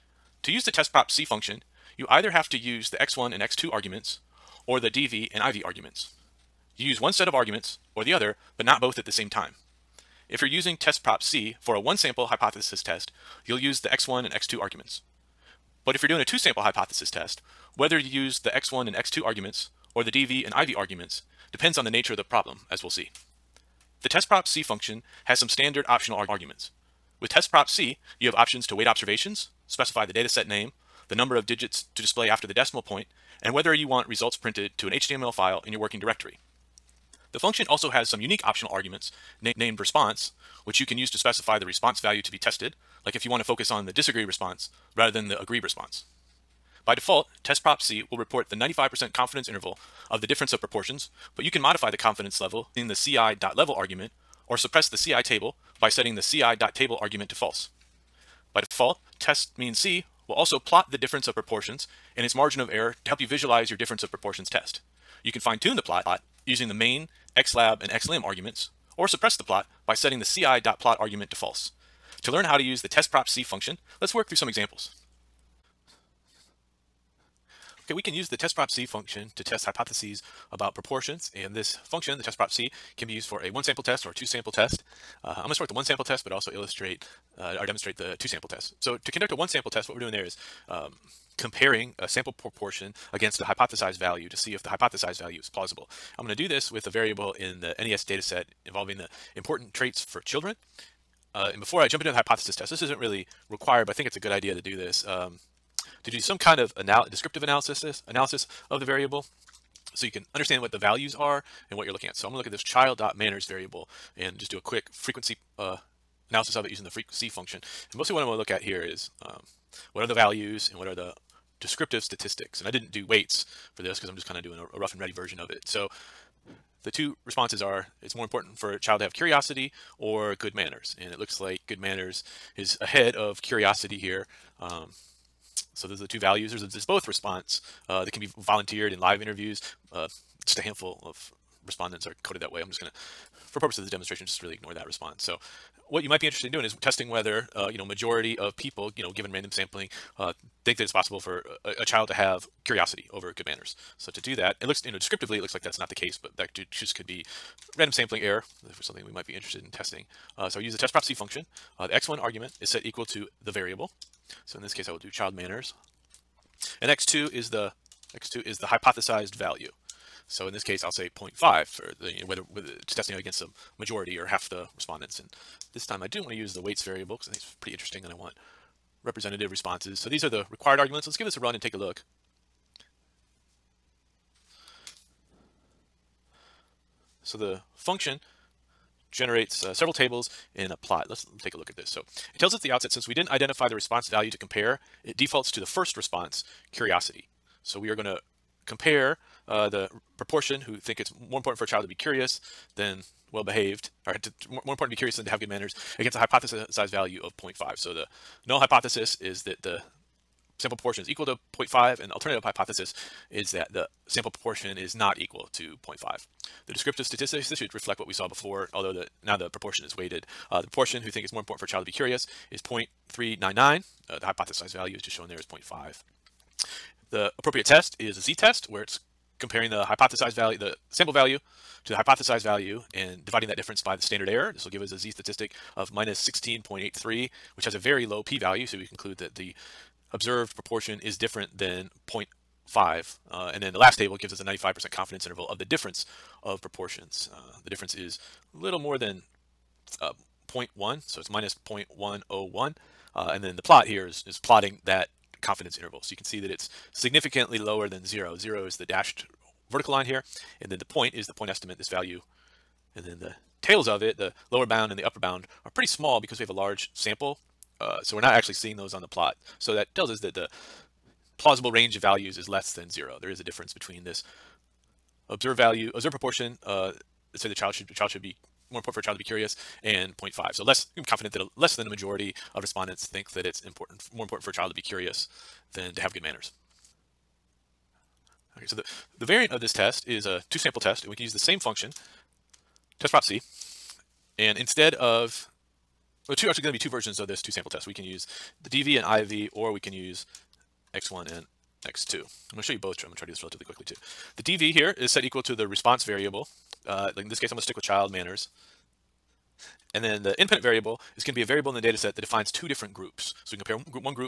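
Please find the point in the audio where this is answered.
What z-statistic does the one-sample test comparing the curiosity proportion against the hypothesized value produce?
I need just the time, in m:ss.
3:55.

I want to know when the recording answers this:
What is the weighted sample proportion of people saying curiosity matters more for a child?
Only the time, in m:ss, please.
3:43.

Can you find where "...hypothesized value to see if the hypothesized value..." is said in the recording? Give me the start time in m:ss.
1:33.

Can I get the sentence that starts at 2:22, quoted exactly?
I'm just going to, for purposes of the demonstration, just really ignore that response.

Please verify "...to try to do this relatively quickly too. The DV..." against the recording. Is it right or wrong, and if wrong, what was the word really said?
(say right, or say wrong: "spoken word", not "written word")
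right.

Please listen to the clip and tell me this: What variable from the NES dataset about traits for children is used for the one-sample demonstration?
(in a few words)
child.manners.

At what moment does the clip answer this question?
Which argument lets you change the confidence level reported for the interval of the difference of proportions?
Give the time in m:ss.
0:52.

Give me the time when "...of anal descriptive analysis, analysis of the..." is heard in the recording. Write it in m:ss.
1:46.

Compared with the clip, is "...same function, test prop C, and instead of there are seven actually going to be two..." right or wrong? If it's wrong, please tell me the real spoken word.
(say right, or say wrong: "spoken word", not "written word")
wrong: "two", not "seven".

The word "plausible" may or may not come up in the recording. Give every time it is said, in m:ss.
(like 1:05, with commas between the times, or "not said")
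1:35, 4:31.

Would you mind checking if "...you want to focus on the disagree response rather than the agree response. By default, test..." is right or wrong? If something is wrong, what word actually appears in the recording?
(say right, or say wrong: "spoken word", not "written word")
right.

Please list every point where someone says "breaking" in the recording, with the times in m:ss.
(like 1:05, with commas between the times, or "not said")
not said.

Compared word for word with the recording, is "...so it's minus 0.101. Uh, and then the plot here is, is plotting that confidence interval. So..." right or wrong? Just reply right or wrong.
right.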